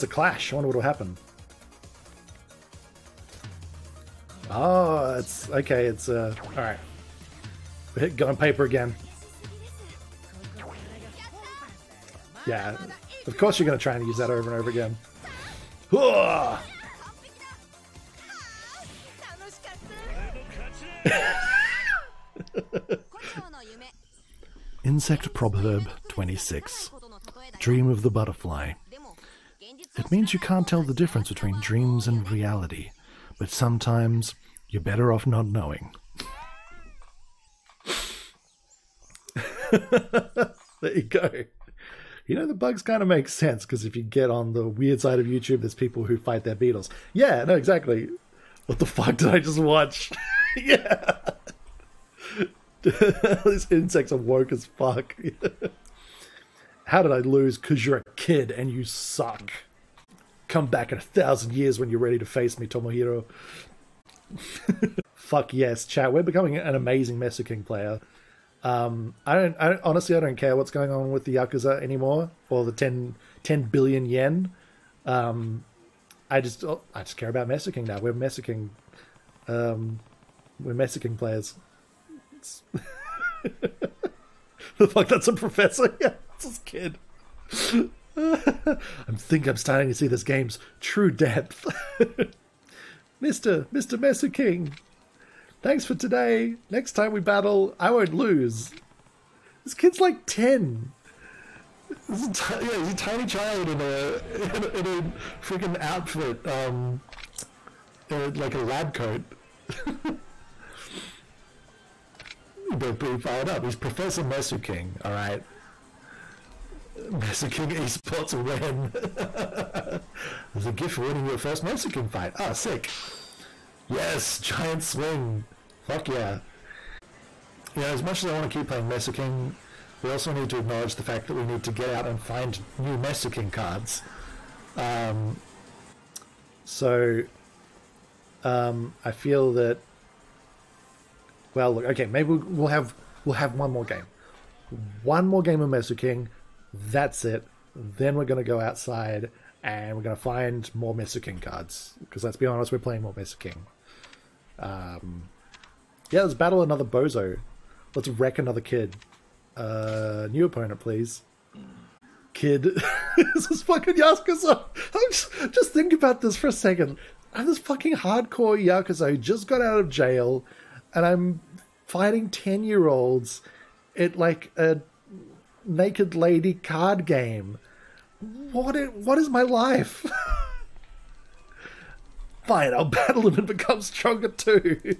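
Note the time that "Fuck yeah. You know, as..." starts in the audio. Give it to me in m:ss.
2:05.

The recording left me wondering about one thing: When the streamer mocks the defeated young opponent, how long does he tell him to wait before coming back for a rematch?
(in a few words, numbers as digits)
1000 years.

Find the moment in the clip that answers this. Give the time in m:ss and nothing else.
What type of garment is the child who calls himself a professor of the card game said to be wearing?
1:48.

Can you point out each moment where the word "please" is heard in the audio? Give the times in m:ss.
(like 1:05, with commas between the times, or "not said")
2:40.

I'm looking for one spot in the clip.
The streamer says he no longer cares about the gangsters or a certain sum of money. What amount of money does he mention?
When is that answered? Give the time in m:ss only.
1:13.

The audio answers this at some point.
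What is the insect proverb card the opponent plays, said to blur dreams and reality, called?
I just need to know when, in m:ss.
0:27.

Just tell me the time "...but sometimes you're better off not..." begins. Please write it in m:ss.
0:33.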